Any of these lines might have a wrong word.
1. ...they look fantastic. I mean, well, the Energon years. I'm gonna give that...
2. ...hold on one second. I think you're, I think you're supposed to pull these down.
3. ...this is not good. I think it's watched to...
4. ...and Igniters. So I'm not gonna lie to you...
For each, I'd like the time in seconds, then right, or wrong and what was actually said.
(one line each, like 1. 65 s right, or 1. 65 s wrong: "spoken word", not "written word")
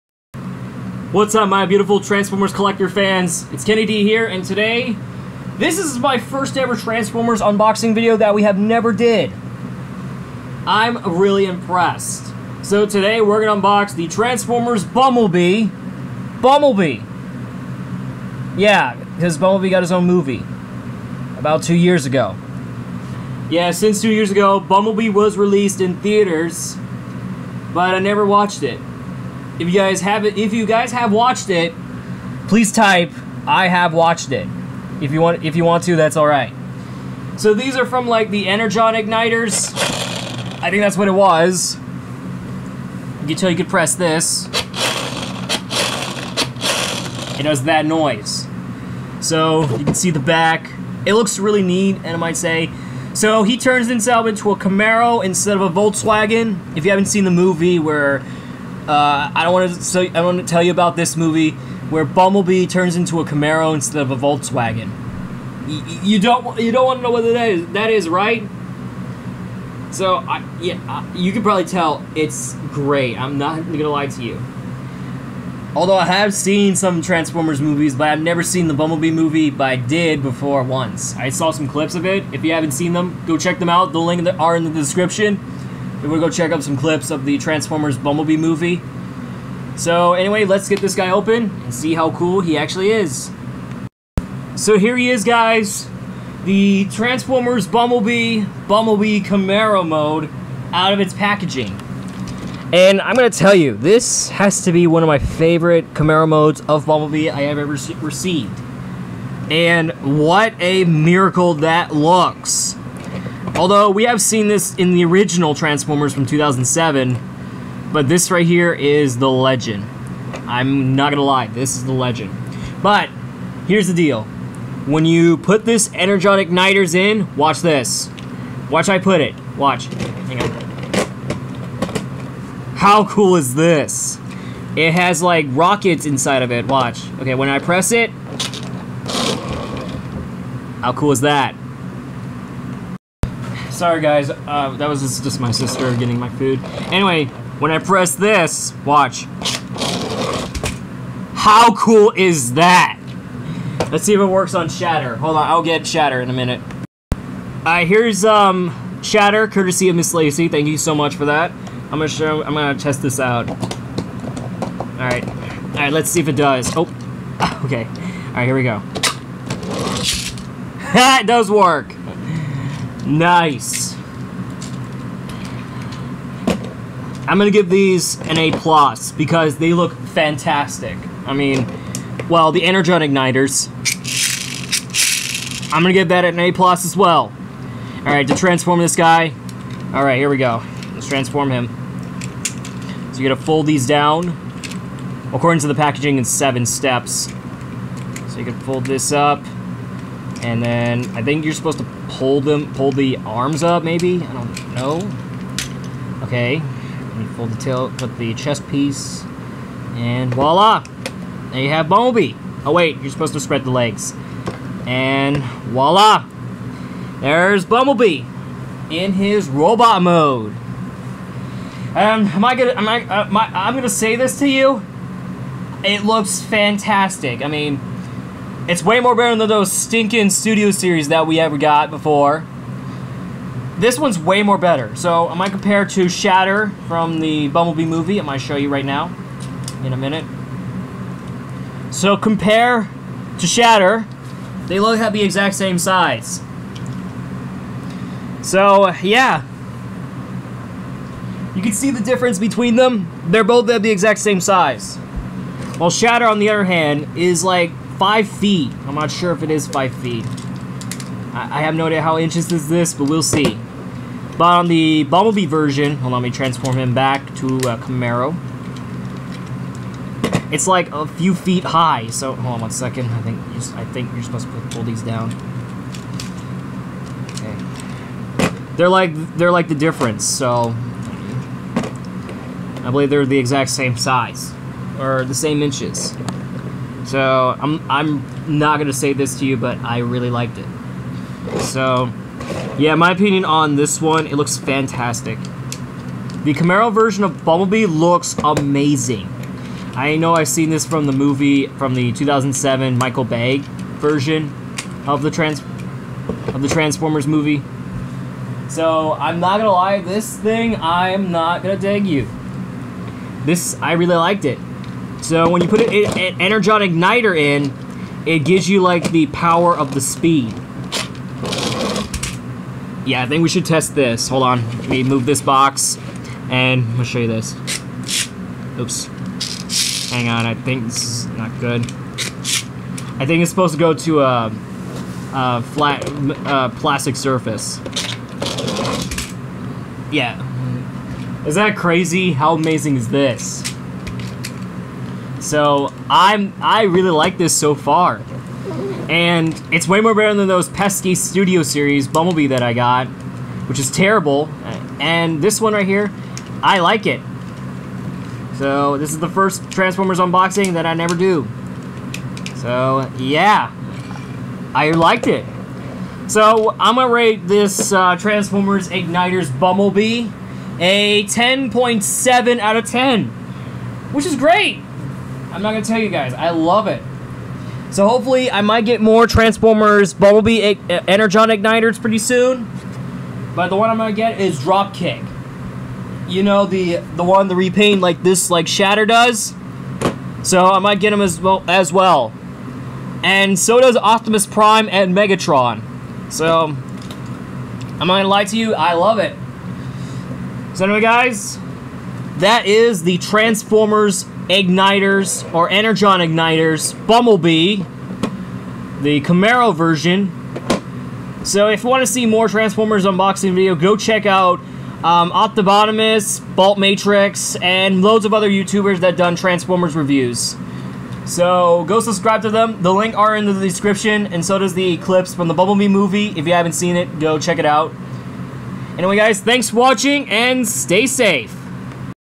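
1. 179 s wrong: "igniters", not "years"
2. 272 s right
3. 330 s wrong: "supposed", not "watched"
4. 394 s wrong: "Megatron", not "Igniters".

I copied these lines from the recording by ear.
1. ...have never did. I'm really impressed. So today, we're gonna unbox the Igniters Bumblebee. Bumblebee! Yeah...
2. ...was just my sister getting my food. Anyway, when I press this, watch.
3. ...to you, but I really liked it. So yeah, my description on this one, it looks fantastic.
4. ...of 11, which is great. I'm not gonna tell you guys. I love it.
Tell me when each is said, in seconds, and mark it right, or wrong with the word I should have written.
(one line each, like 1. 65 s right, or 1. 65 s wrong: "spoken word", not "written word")
1. 8 s wrong: "Transformers", not "Igniters"
2. 144 s right
3. 289 s wrong: "opinion", not "description"
4. 372 s wrong: "10", not "11".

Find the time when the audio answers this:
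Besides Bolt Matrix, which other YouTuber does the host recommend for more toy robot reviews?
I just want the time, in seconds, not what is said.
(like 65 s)
415 s.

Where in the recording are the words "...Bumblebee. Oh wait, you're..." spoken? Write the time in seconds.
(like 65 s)
211 s.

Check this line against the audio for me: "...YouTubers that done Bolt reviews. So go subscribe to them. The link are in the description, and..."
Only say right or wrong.
wrong.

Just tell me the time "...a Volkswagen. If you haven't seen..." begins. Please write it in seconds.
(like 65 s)
55 s.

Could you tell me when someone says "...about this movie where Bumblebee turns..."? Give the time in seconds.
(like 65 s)
60 s.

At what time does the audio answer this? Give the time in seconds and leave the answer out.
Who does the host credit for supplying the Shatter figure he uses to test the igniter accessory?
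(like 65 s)
159 s.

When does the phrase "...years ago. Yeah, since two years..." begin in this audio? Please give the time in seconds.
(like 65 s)
21 s.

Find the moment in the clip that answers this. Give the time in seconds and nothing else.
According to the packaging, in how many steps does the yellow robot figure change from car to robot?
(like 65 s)
196 s.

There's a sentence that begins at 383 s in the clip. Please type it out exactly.
But the one I'm gonna get is Dropkick.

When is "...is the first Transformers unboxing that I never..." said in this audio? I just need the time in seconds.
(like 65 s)
359 s.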